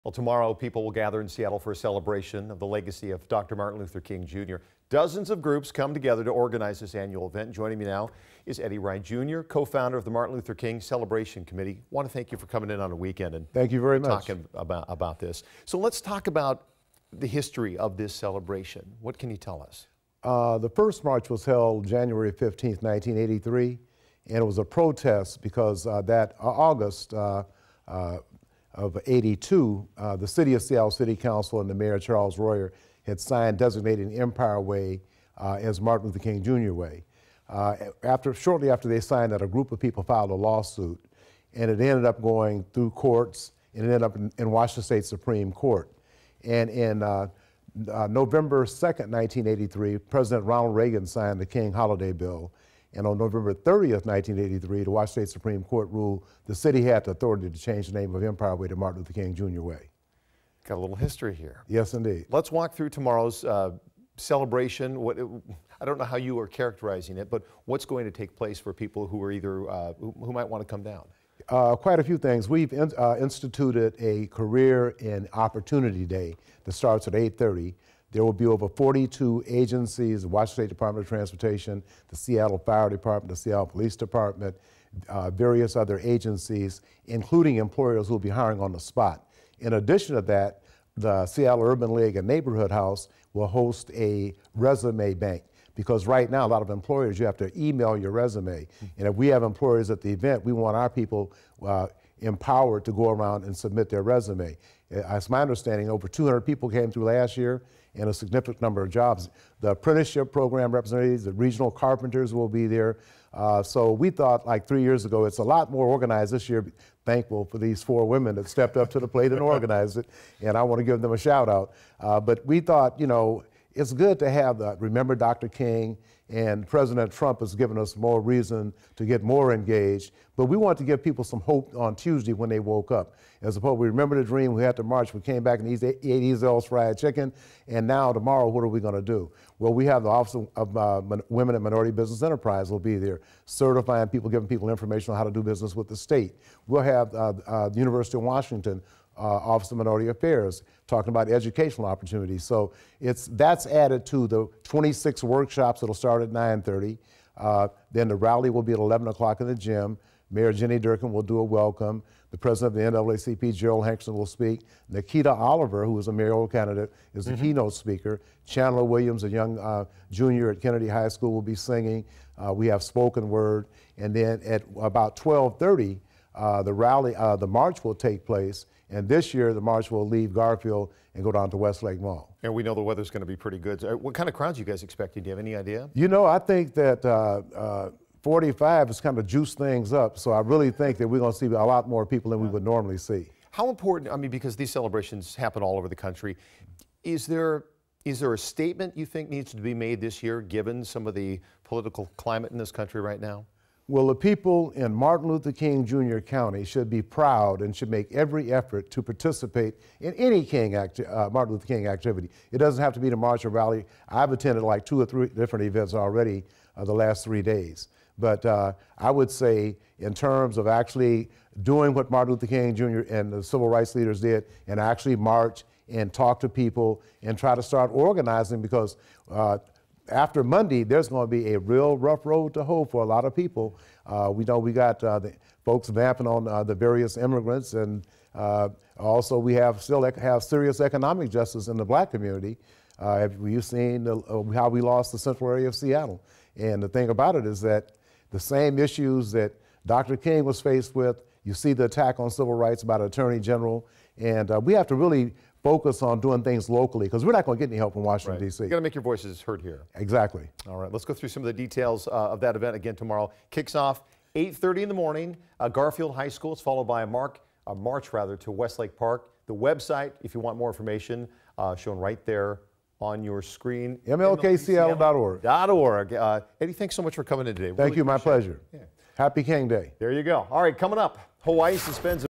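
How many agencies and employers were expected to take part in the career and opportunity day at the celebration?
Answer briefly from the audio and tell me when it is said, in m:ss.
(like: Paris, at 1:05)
42, at 1:18.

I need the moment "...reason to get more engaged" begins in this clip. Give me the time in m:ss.
2:08.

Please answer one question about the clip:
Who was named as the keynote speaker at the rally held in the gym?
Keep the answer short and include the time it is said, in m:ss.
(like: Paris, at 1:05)
Nikita Oliver, at 2:44.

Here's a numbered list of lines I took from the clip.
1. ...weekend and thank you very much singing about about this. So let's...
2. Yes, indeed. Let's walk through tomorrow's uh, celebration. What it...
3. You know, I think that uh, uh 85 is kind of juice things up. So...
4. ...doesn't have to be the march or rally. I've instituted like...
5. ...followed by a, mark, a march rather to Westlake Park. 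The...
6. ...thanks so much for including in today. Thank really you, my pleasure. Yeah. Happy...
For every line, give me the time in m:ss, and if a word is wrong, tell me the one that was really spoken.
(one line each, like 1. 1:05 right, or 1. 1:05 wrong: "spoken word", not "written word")
1. 0:12 wrong: "talking", not "singing"
2. 1:01 right
3. 3:05 wrong: "45", not "85"
4. 3:32 wrong: "attended", not "instituted"
5. 4:26 right
6. 4:36 wrong: "coming", not "including".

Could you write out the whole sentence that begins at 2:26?
We'll have uh, uh, the University of Washington uh, Office of Minority Affairs, talking about educational opportunities.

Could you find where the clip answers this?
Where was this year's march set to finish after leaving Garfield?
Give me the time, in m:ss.
3:01.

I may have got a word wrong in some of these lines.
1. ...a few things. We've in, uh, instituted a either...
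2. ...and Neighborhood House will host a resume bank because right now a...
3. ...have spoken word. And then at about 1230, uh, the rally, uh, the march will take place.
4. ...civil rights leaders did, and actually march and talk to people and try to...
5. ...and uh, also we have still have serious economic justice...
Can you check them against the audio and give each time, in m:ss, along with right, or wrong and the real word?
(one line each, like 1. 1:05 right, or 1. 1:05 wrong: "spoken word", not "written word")
1. 1:11 wrong: "career", not "either"
2. 1:32 right
3. 2:52 right
4. 3:43 right
5. 3:57 right.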